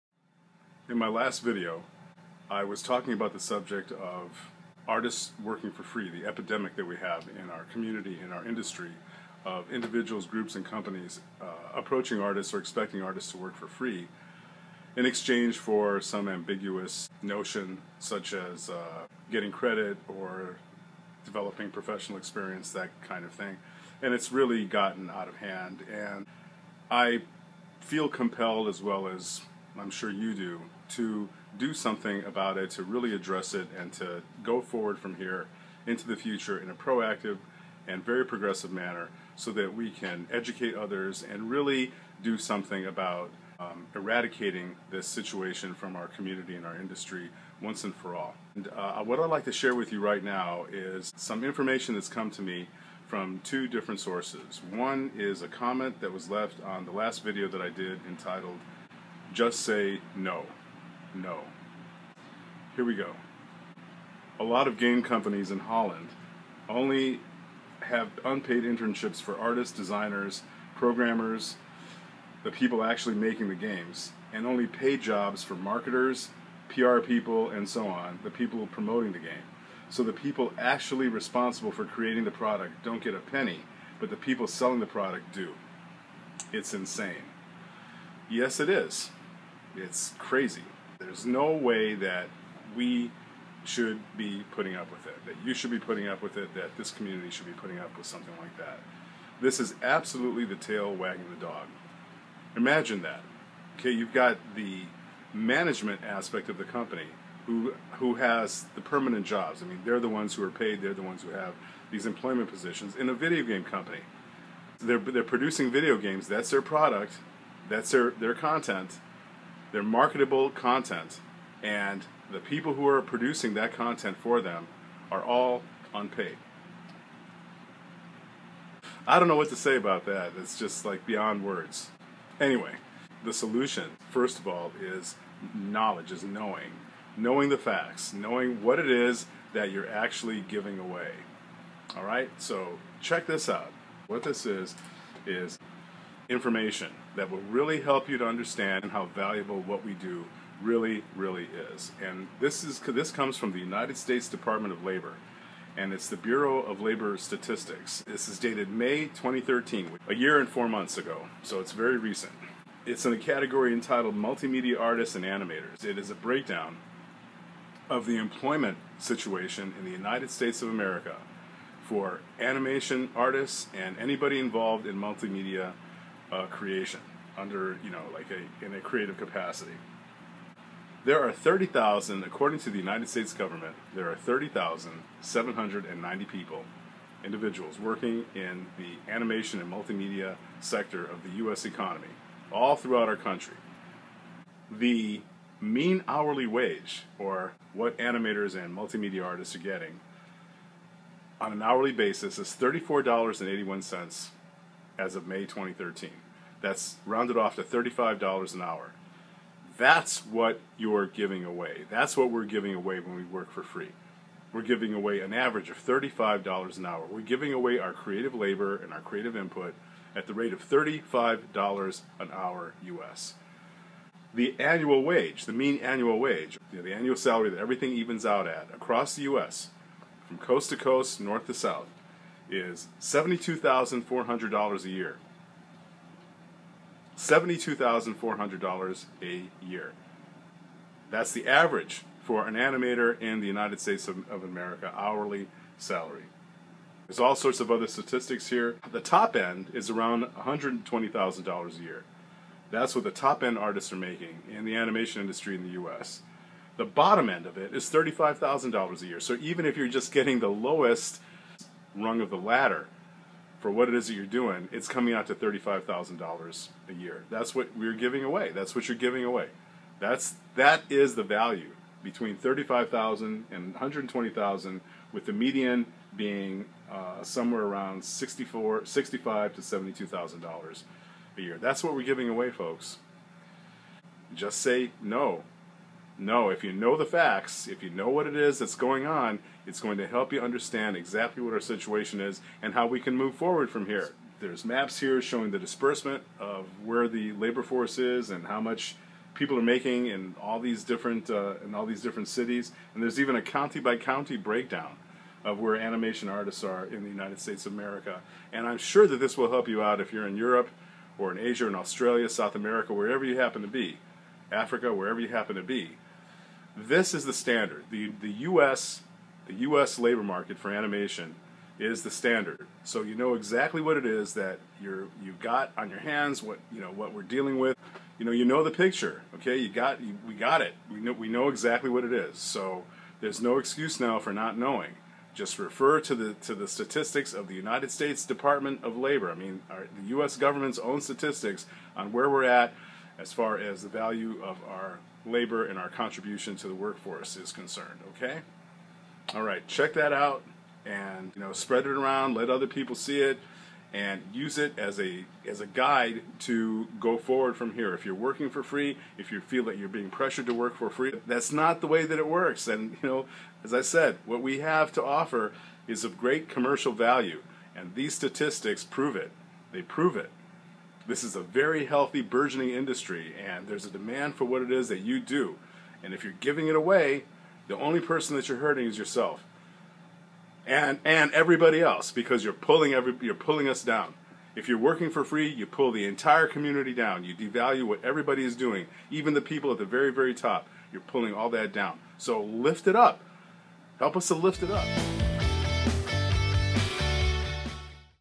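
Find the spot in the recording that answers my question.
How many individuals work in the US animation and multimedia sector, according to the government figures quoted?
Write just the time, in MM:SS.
03:04.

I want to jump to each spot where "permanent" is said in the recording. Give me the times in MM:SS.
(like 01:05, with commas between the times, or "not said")
01:48.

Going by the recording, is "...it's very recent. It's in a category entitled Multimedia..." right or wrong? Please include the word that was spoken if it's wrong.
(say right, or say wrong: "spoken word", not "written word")
right.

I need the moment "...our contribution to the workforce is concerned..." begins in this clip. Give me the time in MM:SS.
05:45.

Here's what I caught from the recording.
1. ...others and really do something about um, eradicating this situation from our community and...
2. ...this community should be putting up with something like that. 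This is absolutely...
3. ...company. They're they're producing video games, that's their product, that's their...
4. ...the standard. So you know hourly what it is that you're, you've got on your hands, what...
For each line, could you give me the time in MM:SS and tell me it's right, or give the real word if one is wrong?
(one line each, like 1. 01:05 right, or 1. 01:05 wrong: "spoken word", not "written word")
1. 00:40 right
2. 01:36 right
3. 01:53 right
4. 05:22 wrong: "exactly", not "hourly".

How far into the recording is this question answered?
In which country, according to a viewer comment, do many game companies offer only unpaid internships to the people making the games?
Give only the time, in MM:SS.
01:05.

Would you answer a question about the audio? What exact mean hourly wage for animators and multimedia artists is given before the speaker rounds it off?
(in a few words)
$34.81.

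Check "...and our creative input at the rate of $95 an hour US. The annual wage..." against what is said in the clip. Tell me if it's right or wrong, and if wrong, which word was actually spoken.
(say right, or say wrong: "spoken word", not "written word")
wrong: "35", not "95".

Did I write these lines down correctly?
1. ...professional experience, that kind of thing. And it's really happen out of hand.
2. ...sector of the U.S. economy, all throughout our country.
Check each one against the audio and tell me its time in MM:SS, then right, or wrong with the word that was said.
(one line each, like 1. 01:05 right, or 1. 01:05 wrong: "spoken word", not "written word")
1. 00:21 wrong: "gotten", not "happen"
2. 03:10 right.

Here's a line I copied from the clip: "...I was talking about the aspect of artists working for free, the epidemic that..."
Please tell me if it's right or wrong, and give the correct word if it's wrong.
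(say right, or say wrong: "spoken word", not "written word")
wrong: "subject", not "aspect".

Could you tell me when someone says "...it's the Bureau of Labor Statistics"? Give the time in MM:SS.
02:35.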